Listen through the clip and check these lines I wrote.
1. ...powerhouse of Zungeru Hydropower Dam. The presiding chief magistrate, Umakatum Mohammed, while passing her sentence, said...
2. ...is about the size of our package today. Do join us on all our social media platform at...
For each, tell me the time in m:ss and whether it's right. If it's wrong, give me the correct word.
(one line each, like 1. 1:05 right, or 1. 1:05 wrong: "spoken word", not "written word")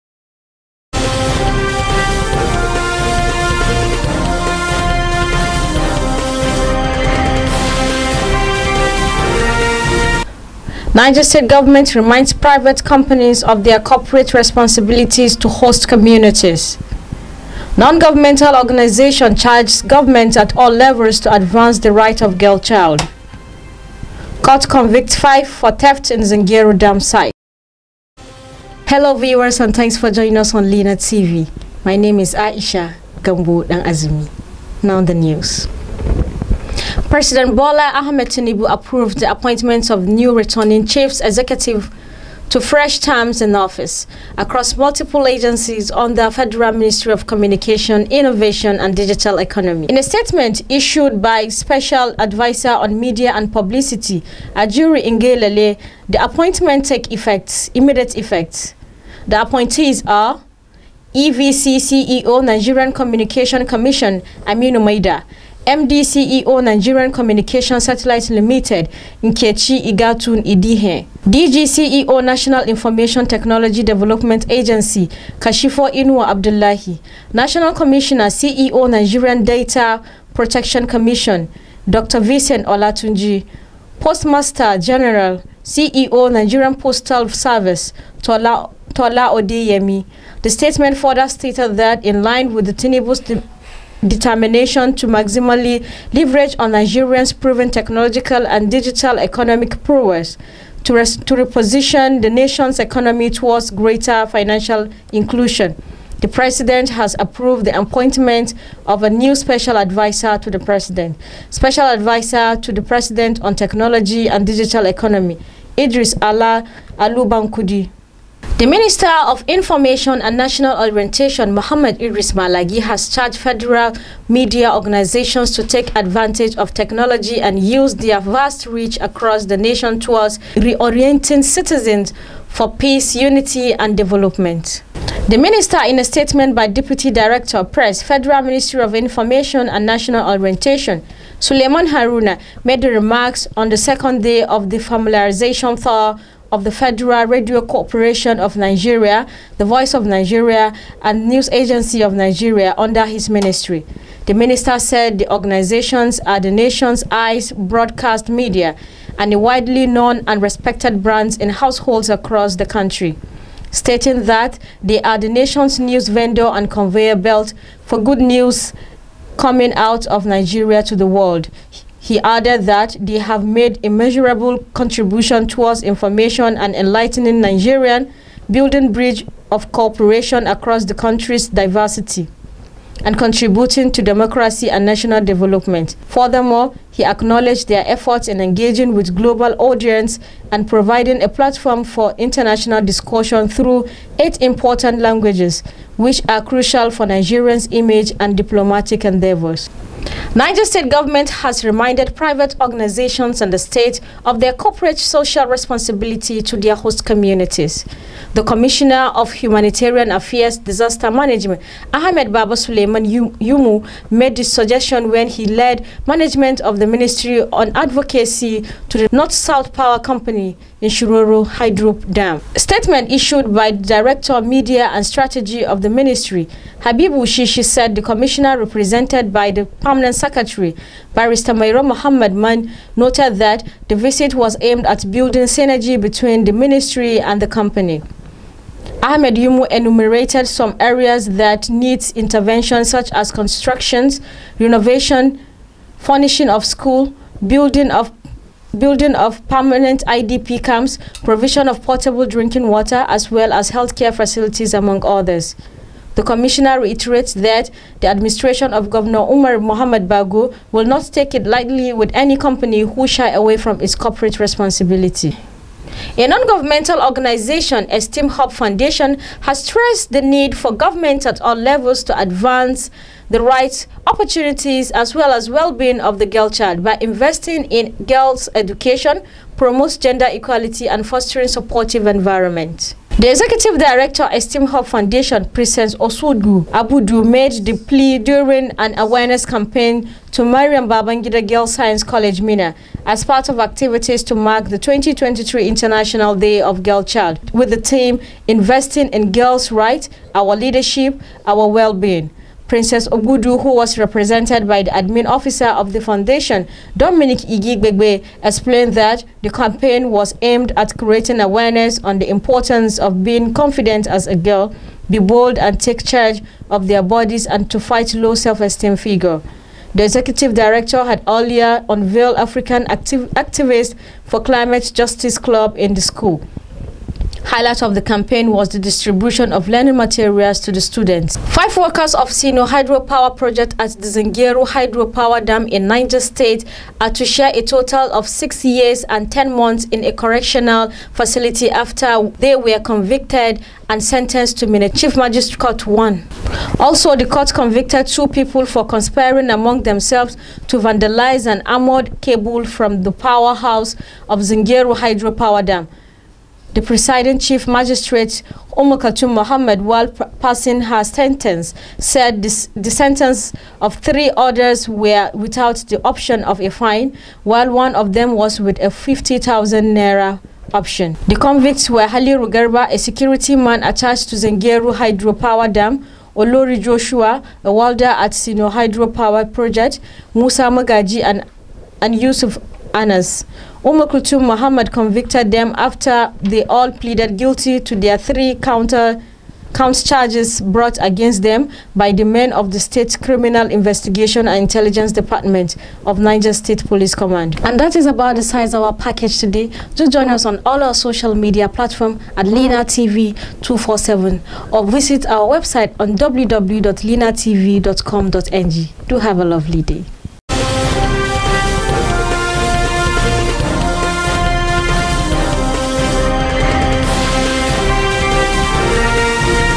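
1. 5:53 right
2. 6:37 right.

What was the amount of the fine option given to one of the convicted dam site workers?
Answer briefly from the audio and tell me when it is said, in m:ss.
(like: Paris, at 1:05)
50,000 naira, at 6:08.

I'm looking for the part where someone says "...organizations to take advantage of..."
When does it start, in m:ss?
2:04.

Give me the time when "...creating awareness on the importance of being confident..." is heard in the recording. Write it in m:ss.
5:10.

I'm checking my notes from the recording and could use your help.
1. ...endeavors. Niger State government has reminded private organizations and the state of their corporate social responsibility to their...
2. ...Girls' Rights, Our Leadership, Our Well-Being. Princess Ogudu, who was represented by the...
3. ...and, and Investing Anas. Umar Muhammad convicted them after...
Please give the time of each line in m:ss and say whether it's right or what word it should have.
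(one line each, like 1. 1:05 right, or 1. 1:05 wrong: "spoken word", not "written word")
1. 3:19 right
2. 4:59 right
3. 6:21 wrong: "Yusuf", not "Investing".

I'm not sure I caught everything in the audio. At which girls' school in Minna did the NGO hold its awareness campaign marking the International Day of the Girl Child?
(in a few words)
Mariam Babangida Girls Science College.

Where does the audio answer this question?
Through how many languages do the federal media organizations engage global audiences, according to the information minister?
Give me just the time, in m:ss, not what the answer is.
3:14.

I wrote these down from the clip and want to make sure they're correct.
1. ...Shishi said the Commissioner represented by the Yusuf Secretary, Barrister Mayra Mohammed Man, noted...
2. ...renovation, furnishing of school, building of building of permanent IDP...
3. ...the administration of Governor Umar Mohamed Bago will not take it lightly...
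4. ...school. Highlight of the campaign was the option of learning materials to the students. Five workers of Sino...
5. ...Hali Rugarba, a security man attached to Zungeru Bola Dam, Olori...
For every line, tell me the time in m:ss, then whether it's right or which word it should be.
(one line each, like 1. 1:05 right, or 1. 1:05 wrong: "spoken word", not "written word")
1. 3:47 wrong: "Permanent", not "Yusuf"
2. 4:04 right
3. 4:18 right
4. 5:25 wrong: "distribution", not "option"
5. 6:12 wrong: "Hydropower", not "Bola".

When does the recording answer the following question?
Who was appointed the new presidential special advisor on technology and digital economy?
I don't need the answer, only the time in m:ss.
1:55.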